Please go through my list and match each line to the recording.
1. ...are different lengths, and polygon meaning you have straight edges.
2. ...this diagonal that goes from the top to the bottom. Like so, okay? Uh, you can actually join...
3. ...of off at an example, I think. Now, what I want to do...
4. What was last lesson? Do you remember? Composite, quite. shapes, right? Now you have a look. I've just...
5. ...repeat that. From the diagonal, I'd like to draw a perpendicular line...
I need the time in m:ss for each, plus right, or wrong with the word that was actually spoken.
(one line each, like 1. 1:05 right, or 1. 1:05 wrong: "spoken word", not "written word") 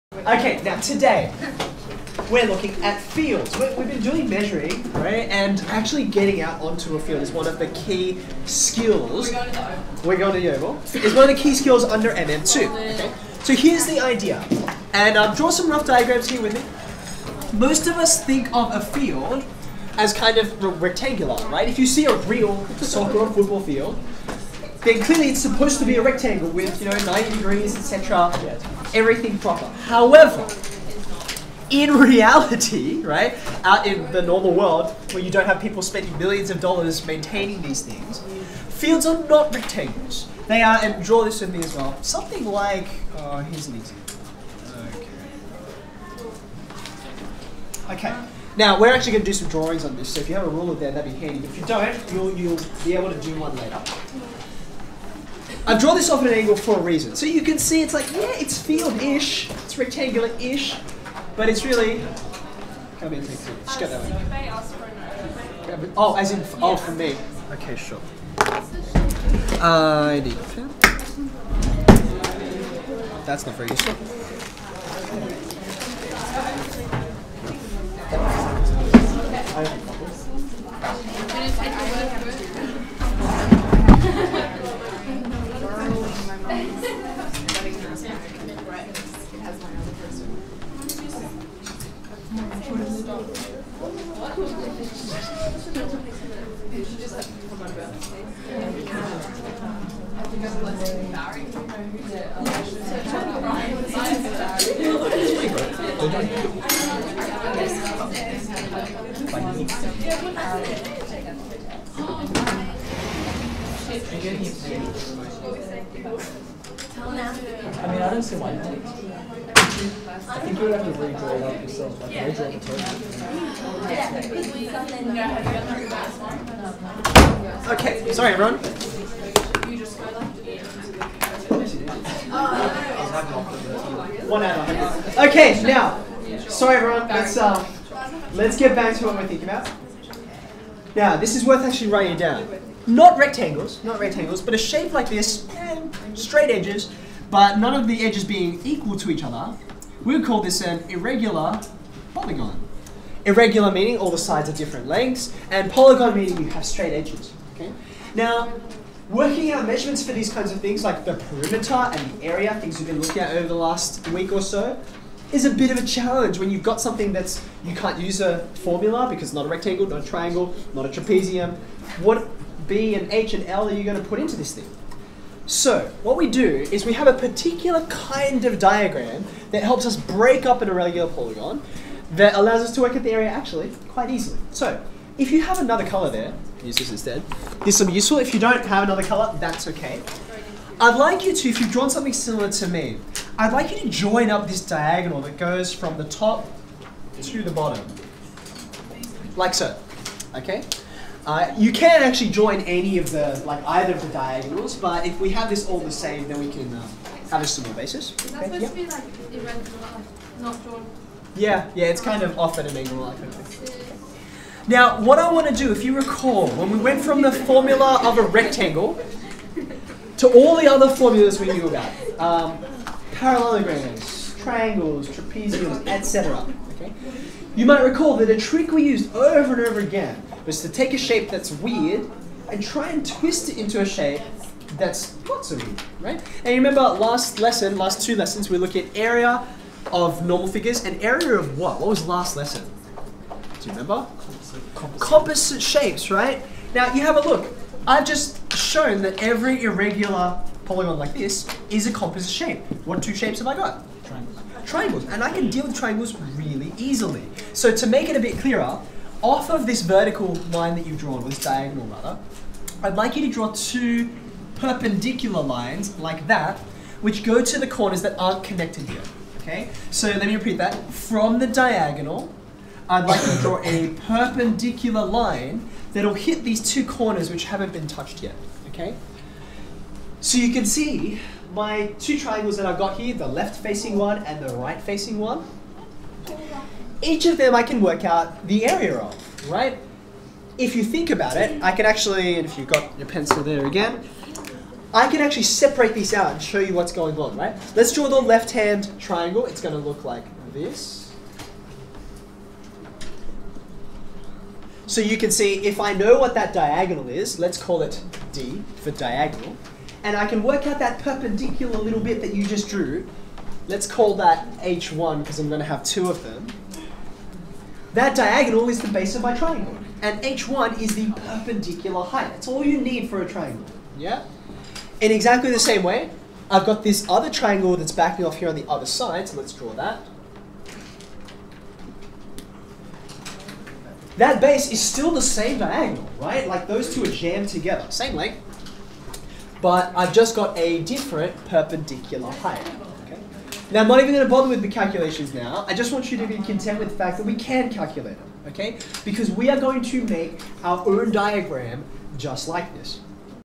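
1. 2:34 right
2. 3:14 right
3. 3:32 wrong: "angle", not "example"
4. 4:01 wrong: "composite", not "quite"
5. 4:30 right.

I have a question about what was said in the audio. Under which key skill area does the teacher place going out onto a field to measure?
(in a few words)
MM2.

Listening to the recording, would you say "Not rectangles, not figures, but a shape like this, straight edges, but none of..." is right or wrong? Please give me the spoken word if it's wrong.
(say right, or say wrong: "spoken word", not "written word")
wrong: "rectangles", not "figures".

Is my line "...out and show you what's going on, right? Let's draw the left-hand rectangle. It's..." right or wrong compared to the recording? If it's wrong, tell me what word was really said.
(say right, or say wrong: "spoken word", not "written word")
wrong: "triangle", not "rectangle".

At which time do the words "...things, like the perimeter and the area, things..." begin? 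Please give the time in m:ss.
2:40.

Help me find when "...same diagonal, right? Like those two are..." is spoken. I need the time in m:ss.
5:35.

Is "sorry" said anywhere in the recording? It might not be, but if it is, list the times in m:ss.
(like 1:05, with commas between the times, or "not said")
2:08, 2:16.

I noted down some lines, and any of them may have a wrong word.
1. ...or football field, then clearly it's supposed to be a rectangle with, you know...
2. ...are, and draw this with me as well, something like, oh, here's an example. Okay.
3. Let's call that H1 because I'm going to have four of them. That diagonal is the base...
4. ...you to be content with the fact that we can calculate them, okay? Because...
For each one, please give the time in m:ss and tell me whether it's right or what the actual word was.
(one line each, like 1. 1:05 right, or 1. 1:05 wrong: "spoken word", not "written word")
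1. 0:23 right
2. 0:40 right
3. 5:13 wrong: "two", not "four"
4. 5:46 right.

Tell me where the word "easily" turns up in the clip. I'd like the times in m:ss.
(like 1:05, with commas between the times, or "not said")
3:04, 4:16.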